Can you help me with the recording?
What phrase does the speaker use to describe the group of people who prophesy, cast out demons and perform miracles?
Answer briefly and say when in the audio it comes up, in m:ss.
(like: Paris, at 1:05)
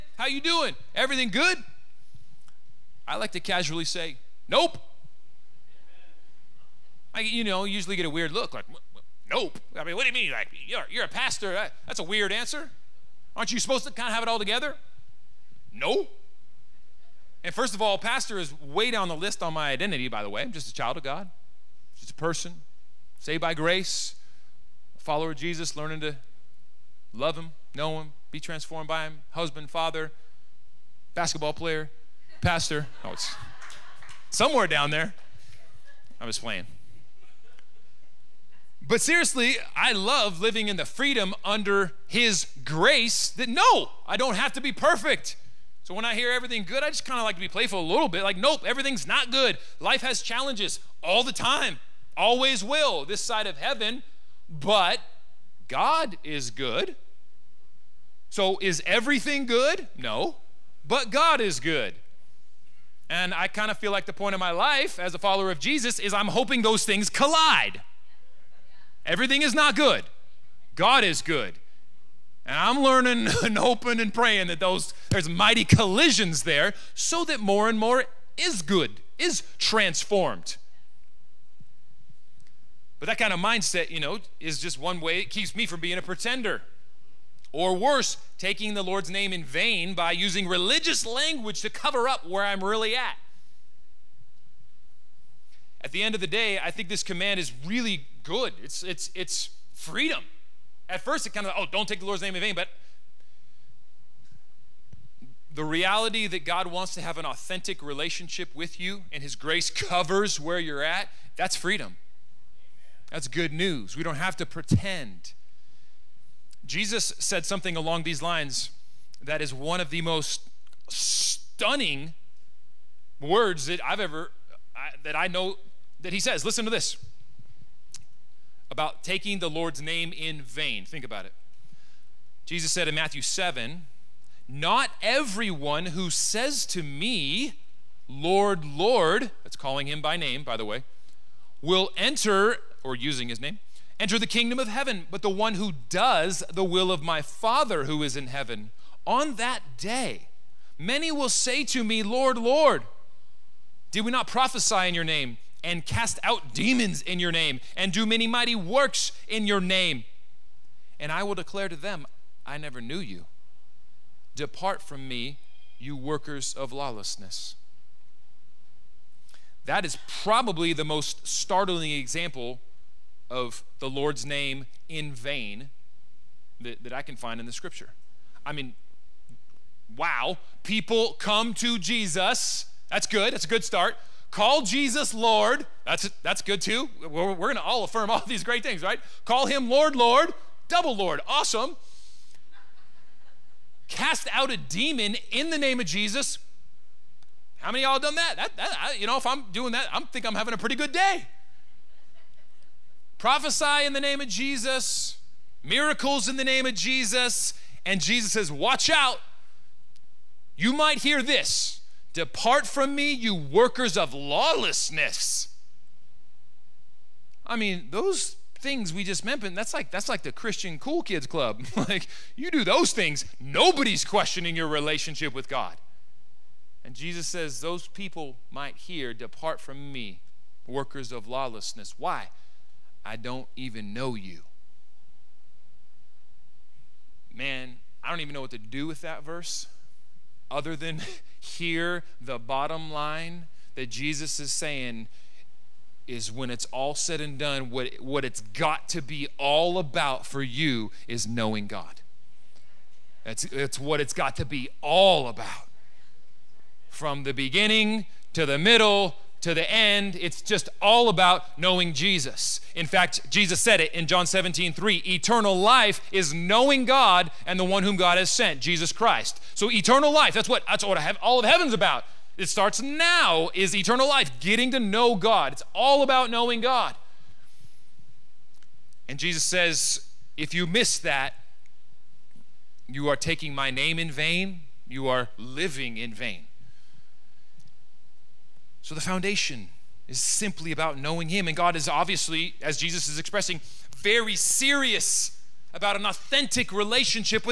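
Christian cool kids club, at 3:40.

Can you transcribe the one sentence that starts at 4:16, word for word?
From the beginning to the middle to the end, it's just all about knowing Jesus.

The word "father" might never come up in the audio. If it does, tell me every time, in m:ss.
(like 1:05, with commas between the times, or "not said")
0:29, 2:27.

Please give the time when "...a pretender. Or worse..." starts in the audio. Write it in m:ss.
1:25.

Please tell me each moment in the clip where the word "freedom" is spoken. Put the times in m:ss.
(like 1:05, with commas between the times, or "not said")
0:40, 1:39, 1:51.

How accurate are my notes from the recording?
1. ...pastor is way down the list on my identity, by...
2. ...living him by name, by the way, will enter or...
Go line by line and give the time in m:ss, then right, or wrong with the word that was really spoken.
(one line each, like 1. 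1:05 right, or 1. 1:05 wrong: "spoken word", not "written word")
1. 0:17 right
2. 2:19 wrong: "calling", not "living".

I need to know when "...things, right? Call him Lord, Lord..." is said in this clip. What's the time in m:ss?
3:08.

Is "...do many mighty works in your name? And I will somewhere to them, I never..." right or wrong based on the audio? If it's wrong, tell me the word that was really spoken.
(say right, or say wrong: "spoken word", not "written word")
wrong: "declare", not "somewhere".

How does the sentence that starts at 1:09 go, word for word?
Everything is not good, God is good.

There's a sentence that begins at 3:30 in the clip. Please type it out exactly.
You might hear this Depart from me, you workers of lawlessness.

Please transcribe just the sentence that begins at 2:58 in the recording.
I mean, wow, people come to Jesus.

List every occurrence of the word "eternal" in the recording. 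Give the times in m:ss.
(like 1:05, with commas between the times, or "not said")
4:25, 4:29, 4:33.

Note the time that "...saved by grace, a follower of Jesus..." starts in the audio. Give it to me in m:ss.
0:23.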